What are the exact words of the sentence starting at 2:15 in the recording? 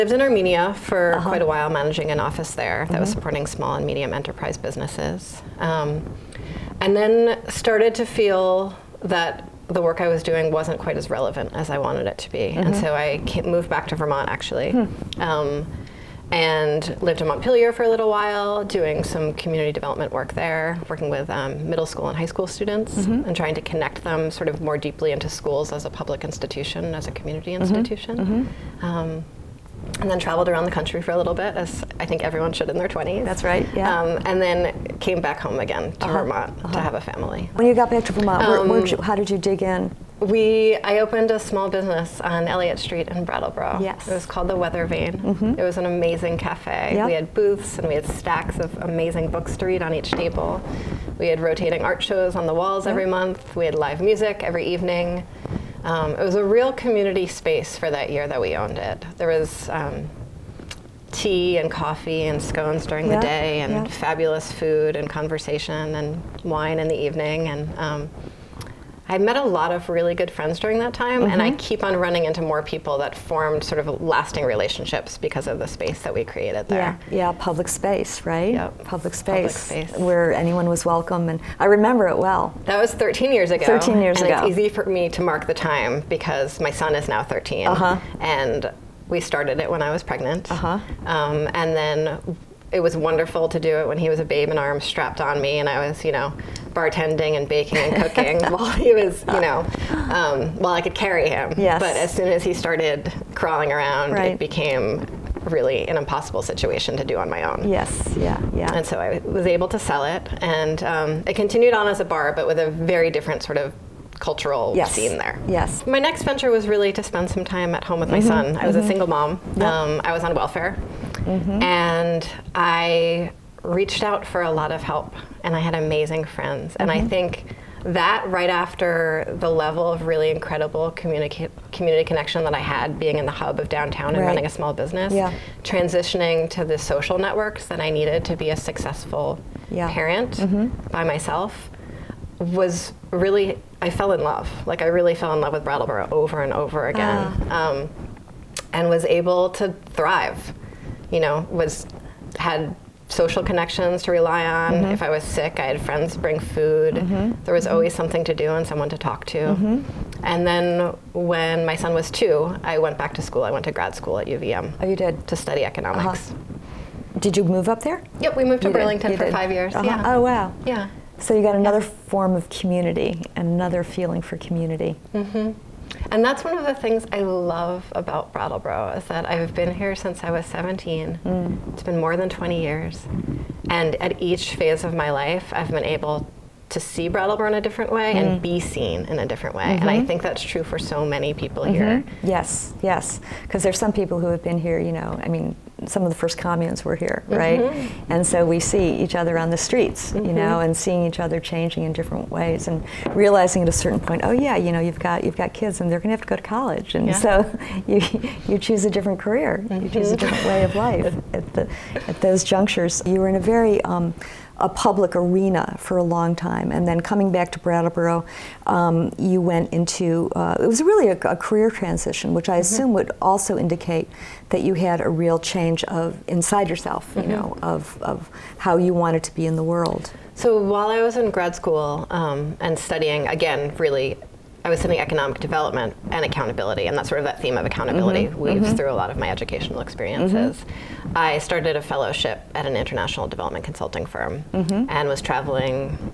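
transitioning to the social networks that I needed to be a successful yeah.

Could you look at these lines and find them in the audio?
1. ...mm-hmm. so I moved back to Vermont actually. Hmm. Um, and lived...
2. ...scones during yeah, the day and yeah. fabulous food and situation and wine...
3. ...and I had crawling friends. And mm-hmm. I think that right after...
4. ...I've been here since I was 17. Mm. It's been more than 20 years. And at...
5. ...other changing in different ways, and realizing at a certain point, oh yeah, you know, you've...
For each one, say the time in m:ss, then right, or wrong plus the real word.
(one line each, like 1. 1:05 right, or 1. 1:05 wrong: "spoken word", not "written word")
1. 0:12 right
2. 1:02 wrong: "conversation", not "situation"
3. 2:05 wrong: "amazing", not "crawling"
4. 2:59 right
5. 3:21 right.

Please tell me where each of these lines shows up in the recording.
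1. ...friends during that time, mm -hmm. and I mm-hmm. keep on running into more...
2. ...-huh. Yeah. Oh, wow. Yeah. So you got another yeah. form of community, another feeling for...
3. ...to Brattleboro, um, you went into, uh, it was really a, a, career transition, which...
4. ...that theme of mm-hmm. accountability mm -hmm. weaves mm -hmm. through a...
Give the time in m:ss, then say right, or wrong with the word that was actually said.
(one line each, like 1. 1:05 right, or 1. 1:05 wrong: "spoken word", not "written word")
1. 1:10 right
2. 2:49 right
3. 3:37 right
4. 3:57 right.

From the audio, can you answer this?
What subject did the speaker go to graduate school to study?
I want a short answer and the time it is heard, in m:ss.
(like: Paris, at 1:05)
Economics, at 2:45.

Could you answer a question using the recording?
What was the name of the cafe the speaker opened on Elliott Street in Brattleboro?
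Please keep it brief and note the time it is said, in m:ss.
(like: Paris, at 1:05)
The Weather Vane, at 0:44.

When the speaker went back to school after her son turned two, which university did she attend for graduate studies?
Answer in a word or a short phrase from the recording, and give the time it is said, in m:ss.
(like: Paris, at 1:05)
UVM, at 2:44.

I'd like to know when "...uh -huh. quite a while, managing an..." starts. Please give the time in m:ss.
0:01.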